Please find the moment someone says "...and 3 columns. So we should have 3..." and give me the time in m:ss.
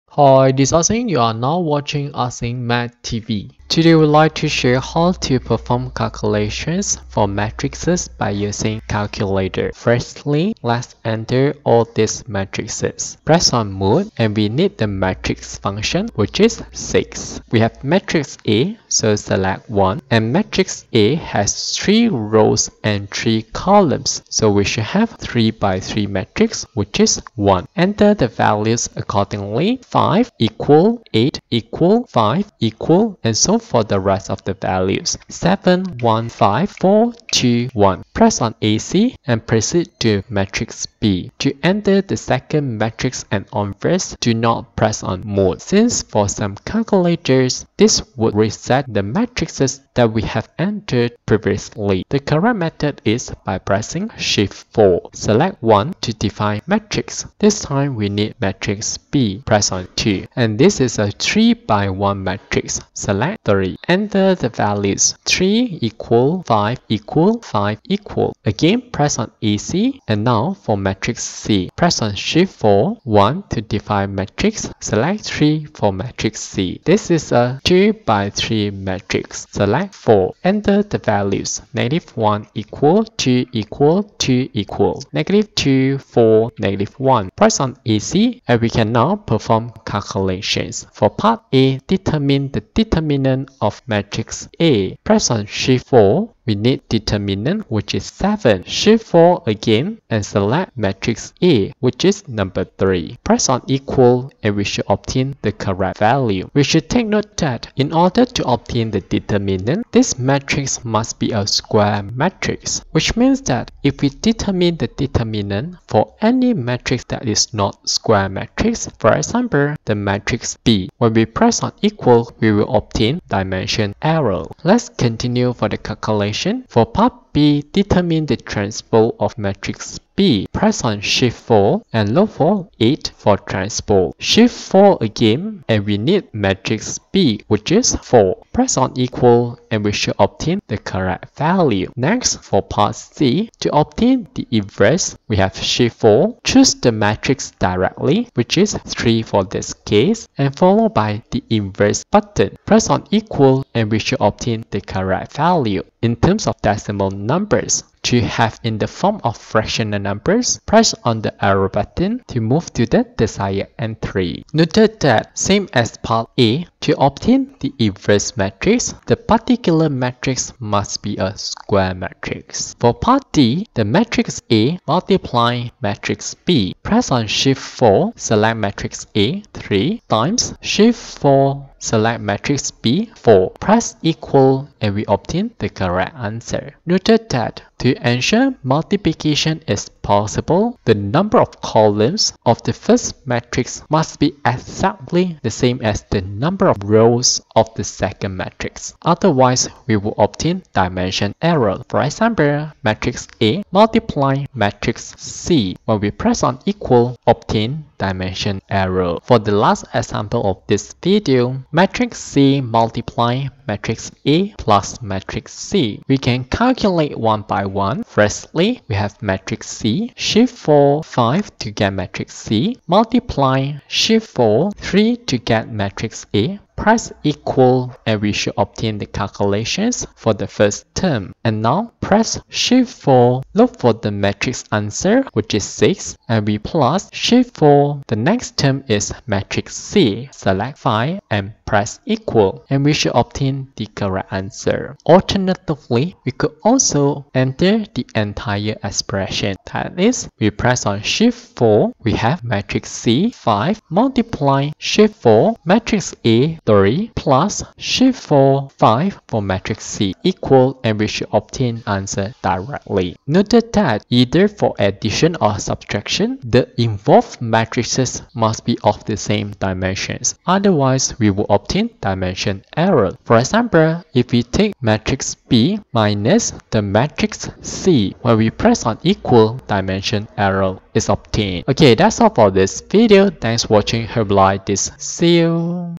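0:22.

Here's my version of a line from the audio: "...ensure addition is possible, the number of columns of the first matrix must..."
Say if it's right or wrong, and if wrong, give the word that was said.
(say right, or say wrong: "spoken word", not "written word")
wrong: "multiplication", not "addition".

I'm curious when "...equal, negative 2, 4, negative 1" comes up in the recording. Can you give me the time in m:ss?
1:24.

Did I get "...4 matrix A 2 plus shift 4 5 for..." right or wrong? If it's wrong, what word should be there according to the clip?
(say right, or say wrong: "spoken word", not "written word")
wrong: "3", not "2".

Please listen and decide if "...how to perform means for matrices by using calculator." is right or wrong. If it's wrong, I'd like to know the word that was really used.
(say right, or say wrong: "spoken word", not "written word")
wrong: "calculations", not "means".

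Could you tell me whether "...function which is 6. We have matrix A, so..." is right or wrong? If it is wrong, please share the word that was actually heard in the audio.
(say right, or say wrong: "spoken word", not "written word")
right.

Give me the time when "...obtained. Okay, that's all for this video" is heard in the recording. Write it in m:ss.
4:41.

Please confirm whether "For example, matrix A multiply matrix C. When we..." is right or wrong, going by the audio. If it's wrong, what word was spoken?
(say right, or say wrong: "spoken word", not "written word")
right.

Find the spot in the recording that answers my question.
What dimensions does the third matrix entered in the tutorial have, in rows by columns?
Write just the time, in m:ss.
1:17.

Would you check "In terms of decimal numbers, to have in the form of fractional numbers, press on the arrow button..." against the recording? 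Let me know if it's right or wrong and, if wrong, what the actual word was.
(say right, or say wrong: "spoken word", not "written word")
right.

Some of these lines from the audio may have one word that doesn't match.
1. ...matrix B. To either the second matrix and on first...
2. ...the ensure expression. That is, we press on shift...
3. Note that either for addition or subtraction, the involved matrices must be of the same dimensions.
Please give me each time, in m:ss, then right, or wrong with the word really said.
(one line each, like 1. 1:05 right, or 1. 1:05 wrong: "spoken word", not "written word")
1. 0:40 wrong: "enter", not "either"
2. 4:07 wrong: "entire", not "ensure"
3. 4:23 right.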